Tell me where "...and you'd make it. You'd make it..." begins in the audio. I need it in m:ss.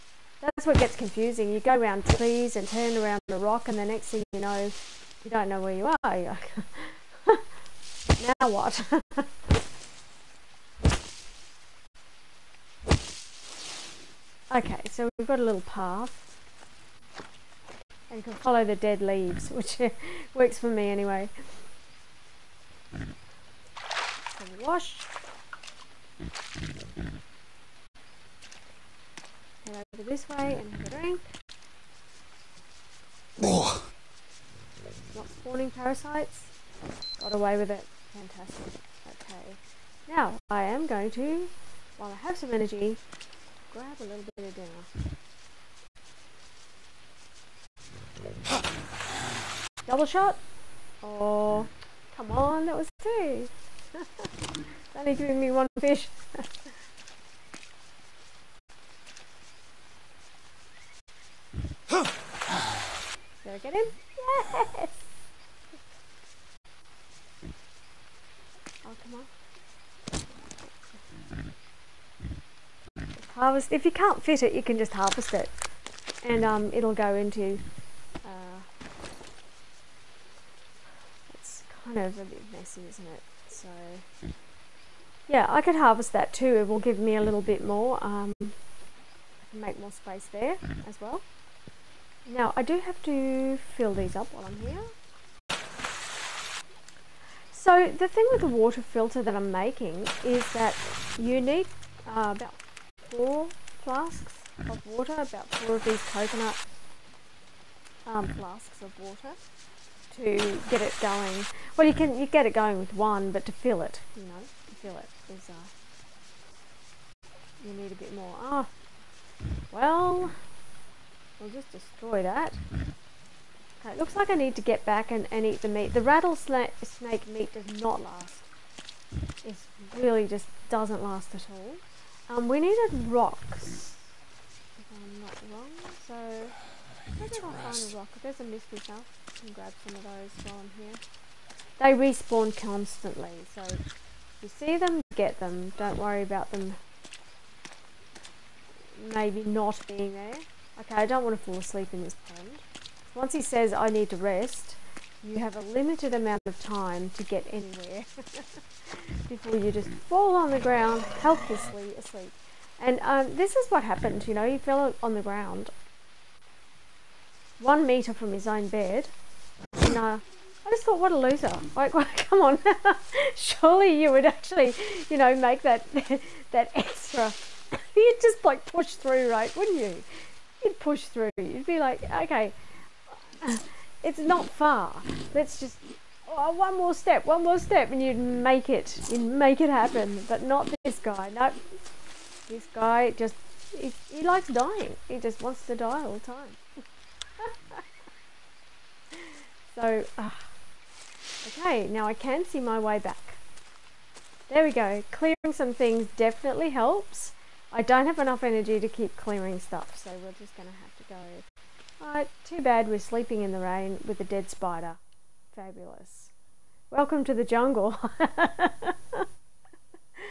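3:07.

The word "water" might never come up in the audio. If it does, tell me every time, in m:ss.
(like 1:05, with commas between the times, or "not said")
1:38, 1:44, 1:48.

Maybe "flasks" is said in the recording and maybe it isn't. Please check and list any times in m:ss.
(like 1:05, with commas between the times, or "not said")
1:43, 1:48.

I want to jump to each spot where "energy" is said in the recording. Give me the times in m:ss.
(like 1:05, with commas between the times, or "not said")
0:42, 3:28.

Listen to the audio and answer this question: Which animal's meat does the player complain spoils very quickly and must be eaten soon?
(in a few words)
rattlesnake.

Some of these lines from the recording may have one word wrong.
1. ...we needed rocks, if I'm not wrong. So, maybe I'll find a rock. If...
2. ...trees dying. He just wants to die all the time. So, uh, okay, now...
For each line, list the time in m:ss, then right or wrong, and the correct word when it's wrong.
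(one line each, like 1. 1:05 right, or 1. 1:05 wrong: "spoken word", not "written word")
1. 2:12 right
2. 3:14 wrong: "likes", not "trees".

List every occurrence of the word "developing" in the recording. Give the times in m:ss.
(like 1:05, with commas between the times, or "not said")
not said.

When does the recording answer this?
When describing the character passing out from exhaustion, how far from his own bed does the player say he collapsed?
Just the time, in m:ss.
2:47.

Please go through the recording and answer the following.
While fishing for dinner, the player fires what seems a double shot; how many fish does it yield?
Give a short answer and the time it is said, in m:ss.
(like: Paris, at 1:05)
1, at 0:55.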